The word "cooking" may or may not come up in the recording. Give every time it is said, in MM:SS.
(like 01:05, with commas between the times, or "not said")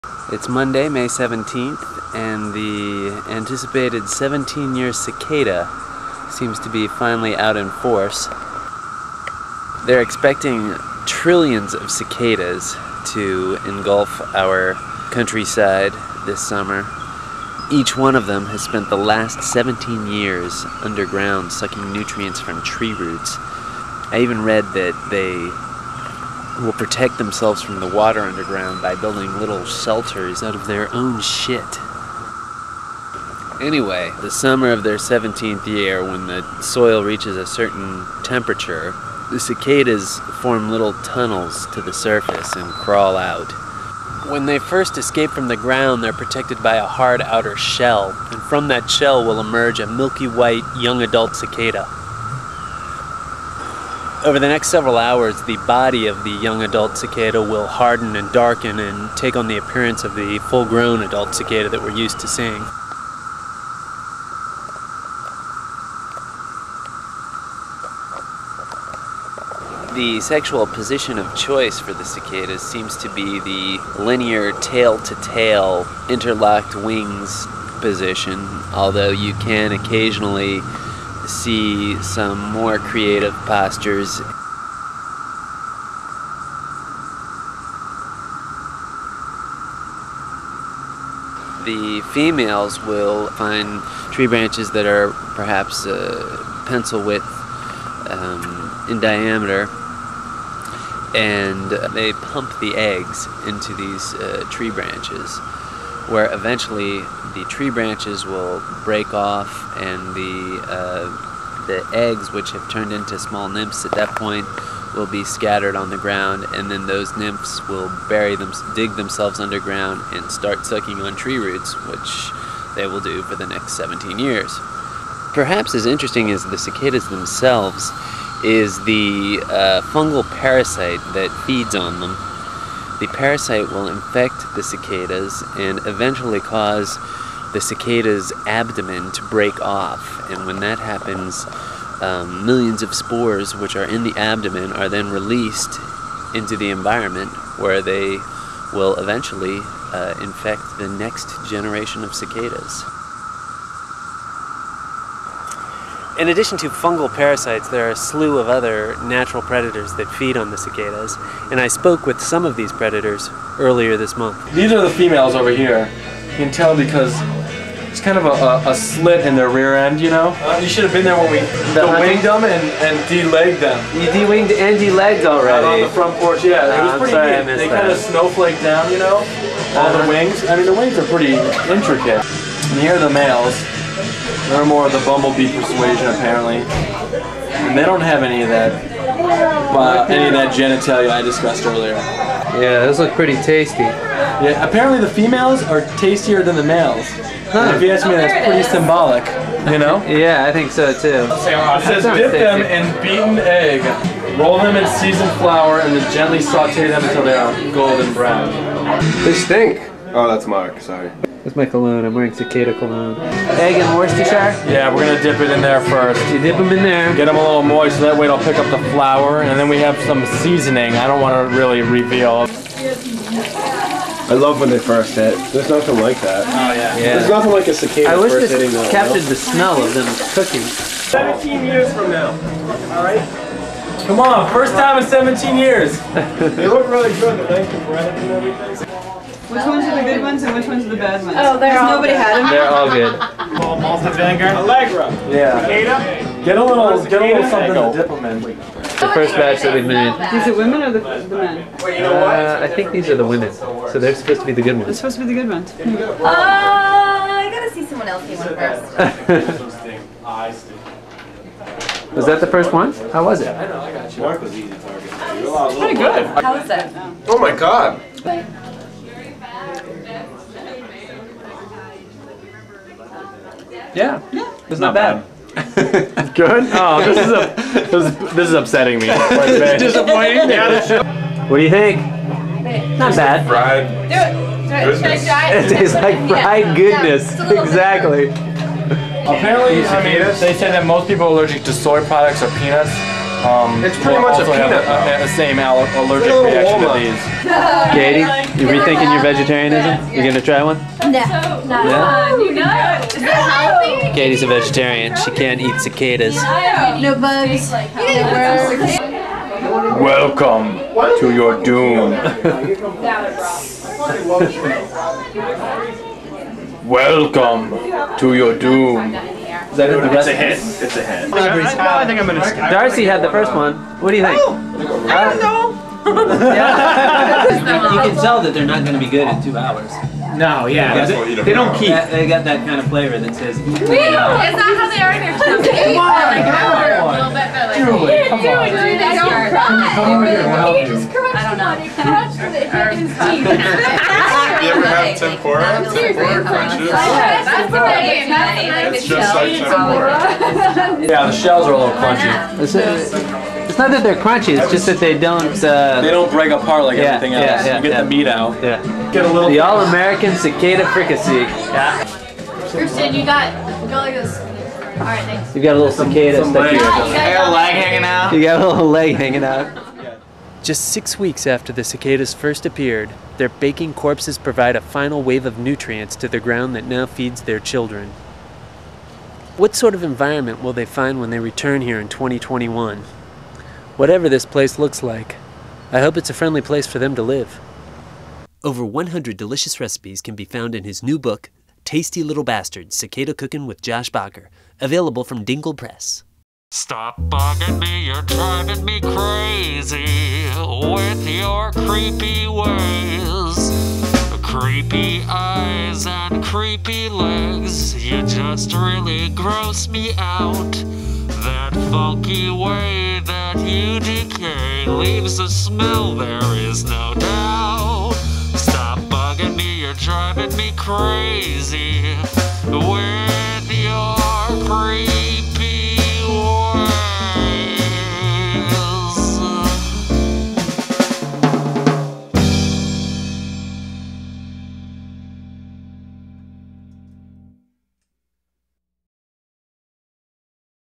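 03:50, 06:33.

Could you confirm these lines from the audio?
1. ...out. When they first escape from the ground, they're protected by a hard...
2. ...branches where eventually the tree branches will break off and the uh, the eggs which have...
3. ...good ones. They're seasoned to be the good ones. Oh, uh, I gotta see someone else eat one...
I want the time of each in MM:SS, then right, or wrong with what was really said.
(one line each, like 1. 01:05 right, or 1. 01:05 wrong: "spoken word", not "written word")
1. 00:43 right
2. 01:44 right
3. 04:14 wrong: "supposed", not "seasoned".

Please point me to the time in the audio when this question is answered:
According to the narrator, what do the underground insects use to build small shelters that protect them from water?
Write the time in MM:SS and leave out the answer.
00:30.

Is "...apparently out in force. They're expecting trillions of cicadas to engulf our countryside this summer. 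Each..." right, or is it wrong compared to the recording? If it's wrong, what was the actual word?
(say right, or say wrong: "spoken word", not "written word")
wrong: "finally", not "apparently".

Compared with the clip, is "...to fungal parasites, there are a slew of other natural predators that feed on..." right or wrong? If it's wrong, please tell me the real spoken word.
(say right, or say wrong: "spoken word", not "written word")
right.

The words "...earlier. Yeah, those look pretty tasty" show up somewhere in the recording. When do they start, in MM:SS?
03:11.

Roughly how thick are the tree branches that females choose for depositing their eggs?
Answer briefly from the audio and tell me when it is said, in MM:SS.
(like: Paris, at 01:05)
pencil width, at 01:36.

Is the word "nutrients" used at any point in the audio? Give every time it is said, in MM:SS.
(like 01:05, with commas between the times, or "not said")
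00:21, 06:15.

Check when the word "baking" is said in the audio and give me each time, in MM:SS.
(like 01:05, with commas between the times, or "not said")
06:13.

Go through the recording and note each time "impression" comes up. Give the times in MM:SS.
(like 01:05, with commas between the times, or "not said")
not said.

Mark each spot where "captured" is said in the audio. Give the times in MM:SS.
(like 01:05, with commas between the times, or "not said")
03:48.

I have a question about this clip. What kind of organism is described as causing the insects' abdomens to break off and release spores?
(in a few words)
fungal parasite.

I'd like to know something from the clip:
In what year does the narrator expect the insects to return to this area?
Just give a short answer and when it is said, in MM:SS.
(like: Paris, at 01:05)
2021, at 06:22.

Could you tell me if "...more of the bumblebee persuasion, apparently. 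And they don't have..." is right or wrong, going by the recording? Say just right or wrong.
right.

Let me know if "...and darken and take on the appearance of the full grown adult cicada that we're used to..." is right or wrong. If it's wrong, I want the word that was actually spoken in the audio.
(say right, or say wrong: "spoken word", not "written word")
right.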